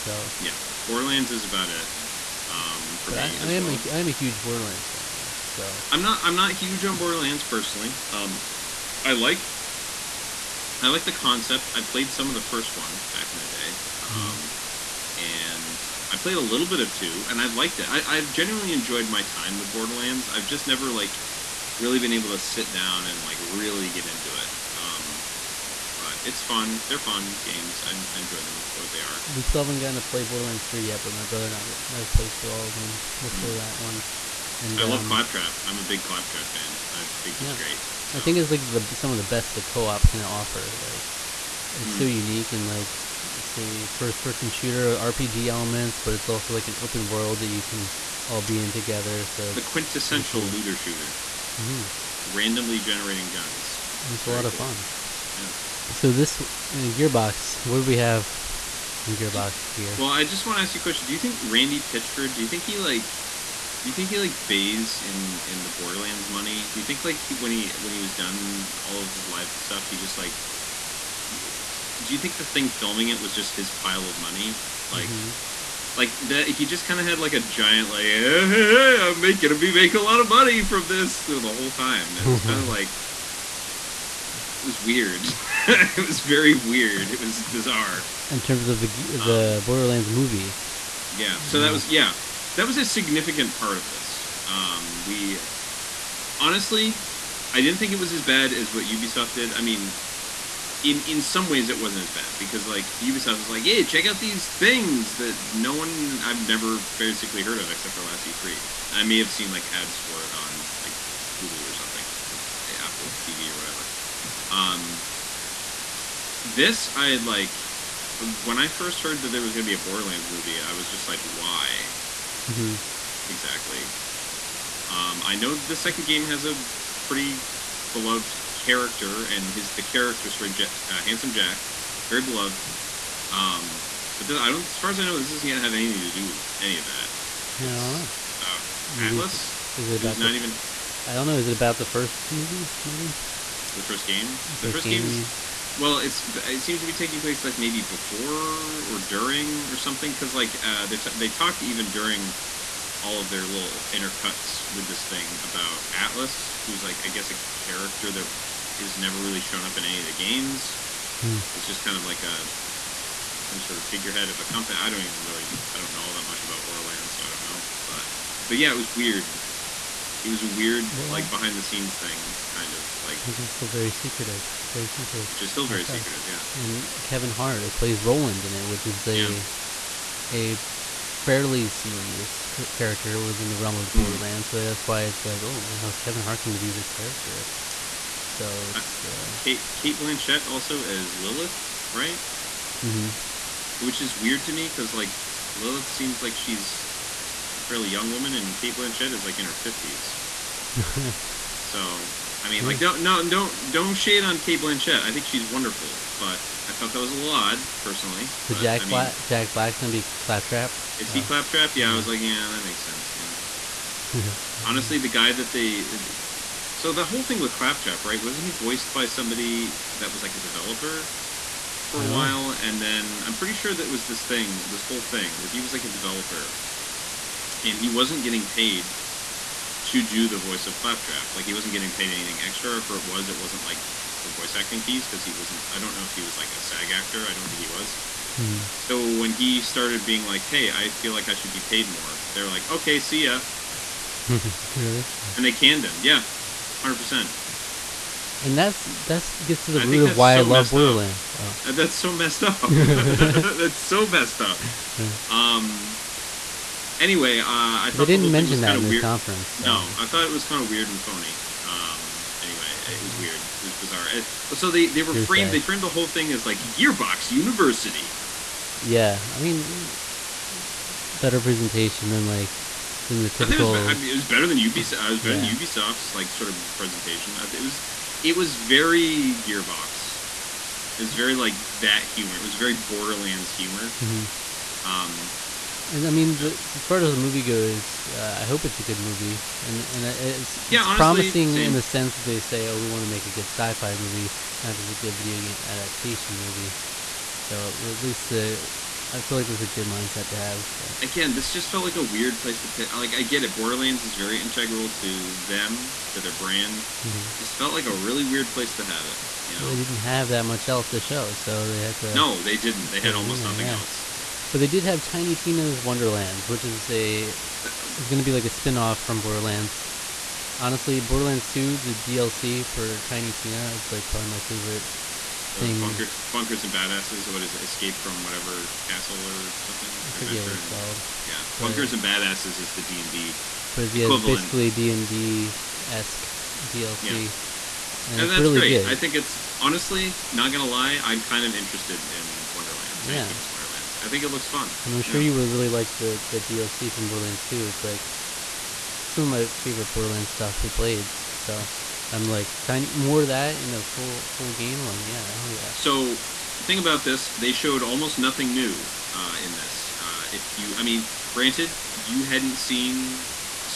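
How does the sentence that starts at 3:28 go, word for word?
But, but Jack I mean, Black Jack Black's gonna be Claptrap.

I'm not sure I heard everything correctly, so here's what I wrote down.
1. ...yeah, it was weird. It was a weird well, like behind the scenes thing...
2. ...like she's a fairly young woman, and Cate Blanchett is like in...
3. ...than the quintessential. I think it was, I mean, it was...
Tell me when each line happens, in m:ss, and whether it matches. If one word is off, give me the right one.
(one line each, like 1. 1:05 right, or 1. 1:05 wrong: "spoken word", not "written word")
1. 2:48 right
2. 3:16 right
3. 4:33 wrong: "typical", not "quintessential".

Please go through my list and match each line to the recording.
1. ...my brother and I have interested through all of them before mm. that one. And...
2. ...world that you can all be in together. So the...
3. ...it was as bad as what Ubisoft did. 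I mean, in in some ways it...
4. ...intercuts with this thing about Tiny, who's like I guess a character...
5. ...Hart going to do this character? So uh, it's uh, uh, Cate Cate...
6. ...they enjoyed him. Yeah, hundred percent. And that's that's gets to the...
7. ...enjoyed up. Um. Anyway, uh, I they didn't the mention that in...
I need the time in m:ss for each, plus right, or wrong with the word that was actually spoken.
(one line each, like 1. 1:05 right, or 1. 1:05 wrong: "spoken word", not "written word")
1. 0:31 wrong: "played", not "interested"
2. 0:47 right
3. 1:37 right
4. 2:33 wrong: "Atlas", not "Tiny"
5. 3:06 right
6. 4:05 wrong: "canned", not "enjoyed"
7. 4:14 wrong: "messed", not "enjoyed".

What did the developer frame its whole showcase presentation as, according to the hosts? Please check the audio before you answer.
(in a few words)
Gearbox University.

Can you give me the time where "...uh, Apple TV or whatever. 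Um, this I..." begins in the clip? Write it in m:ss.
1:52.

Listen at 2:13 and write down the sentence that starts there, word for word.
Um, but this, I don't, as far as I know, this isn't gonna have anything to do with any of that.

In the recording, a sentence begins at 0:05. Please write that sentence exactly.
So I'm not I'm not huge on Borderlands personally.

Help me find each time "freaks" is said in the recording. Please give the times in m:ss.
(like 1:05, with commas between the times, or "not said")
not said.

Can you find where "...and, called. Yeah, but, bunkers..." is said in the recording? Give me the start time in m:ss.
5:30.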